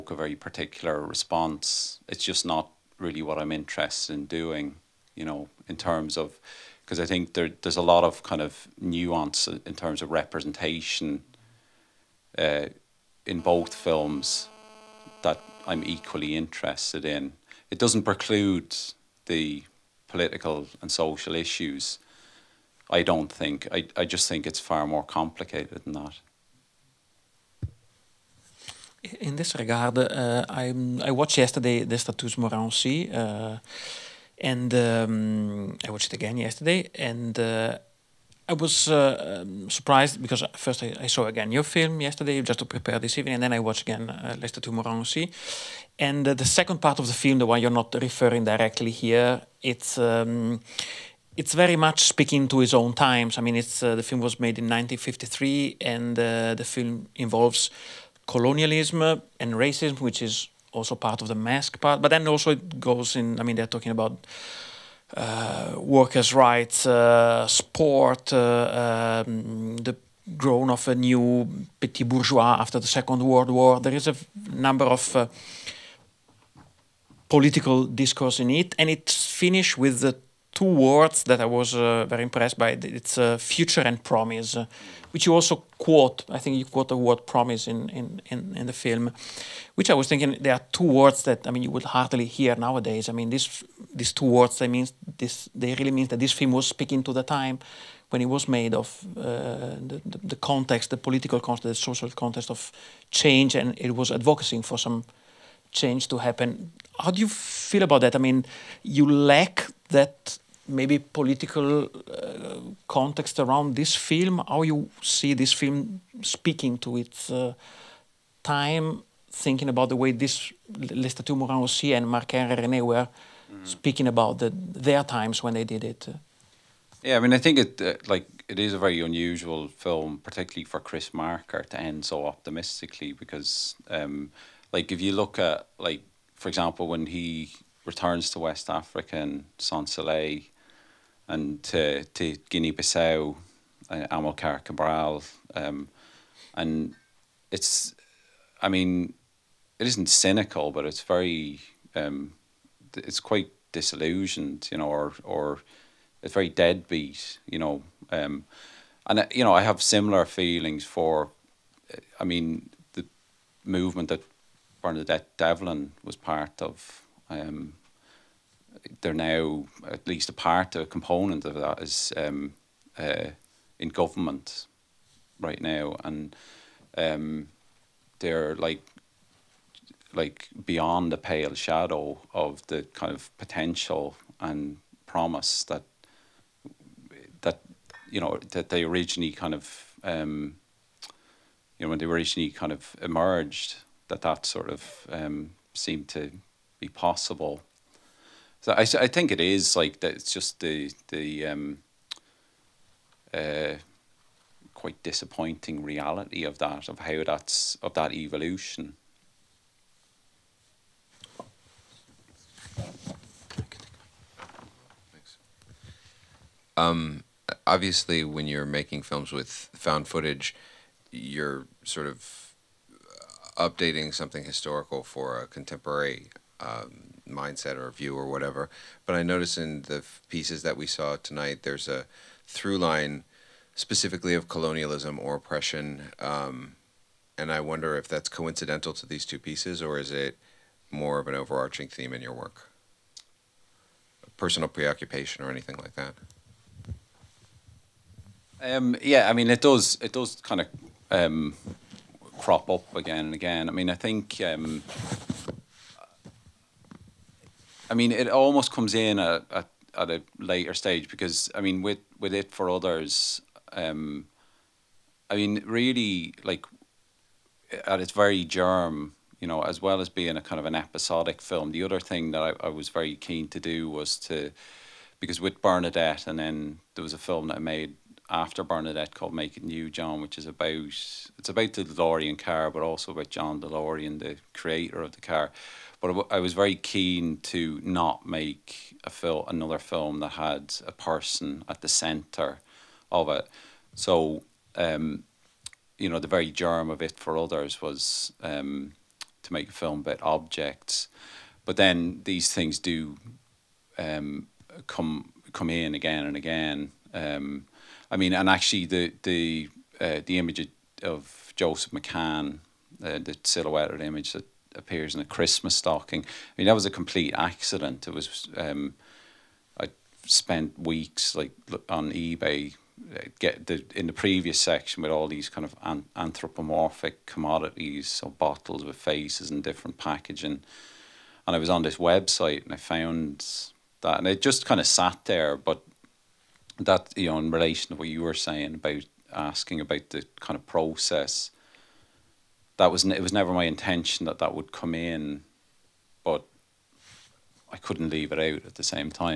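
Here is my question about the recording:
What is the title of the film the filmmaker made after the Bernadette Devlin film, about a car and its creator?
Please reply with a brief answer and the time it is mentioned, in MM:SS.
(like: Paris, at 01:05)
Make It New John, at 04:39.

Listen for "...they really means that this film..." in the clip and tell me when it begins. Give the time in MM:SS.
01:35.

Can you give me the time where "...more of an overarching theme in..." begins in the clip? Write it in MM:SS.
04:00.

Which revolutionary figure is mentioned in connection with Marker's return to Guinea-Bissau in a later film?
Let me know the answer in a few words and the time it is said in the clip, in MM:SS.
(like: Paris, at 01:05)
Amilcar Cabral, at 02:24.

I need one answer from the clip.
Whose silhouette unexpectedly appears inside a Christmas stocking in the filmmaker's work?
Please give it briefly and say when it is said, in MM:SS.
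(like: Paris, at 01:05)
Joseph McCann, at 05:11.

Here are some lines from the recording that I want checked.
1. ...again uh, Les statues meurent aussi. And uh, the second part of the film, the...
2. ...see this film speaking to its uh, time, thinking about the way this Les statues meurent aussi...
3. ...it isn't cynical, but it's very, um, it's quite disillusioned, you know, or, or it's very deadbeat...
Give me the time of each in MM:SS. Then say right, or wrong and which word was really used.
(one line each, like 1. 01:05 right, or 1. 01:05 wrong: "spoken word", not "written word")
1. 00:43 right
2. 01:55 right
3. 02:29 right.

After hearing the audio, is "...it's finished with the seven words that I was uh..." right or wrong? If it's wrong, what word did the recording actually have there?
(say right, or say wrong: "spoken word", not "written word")
wrong: "two", not "seven".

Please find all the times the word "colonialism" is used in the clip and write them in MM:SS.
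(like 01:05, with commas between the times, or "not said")
00:58, 03:54.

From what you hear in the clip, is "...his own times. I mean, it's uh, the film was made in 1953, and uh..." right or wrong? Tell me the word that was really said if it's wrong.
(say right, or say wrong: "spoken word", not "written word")
right.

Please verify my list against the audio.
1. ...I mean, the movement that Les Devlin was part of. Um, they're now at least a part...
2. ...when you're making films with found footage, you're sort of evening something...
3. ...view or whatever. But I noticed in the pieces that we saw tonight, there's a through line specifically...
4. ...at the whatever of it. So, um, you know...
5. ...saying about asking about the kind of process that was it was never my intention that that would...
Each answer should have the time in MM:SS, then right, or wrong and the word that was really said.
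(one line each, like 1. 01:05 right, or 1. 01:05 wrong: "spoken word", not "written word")
1. 02:42 wrong: "Bernadette", not "Les"
2. 03:38 wrong: "updating", not "evening"
3. 03:47 right
4. 04:51 wrong: "center", not "whatever"
5. 05:38 right.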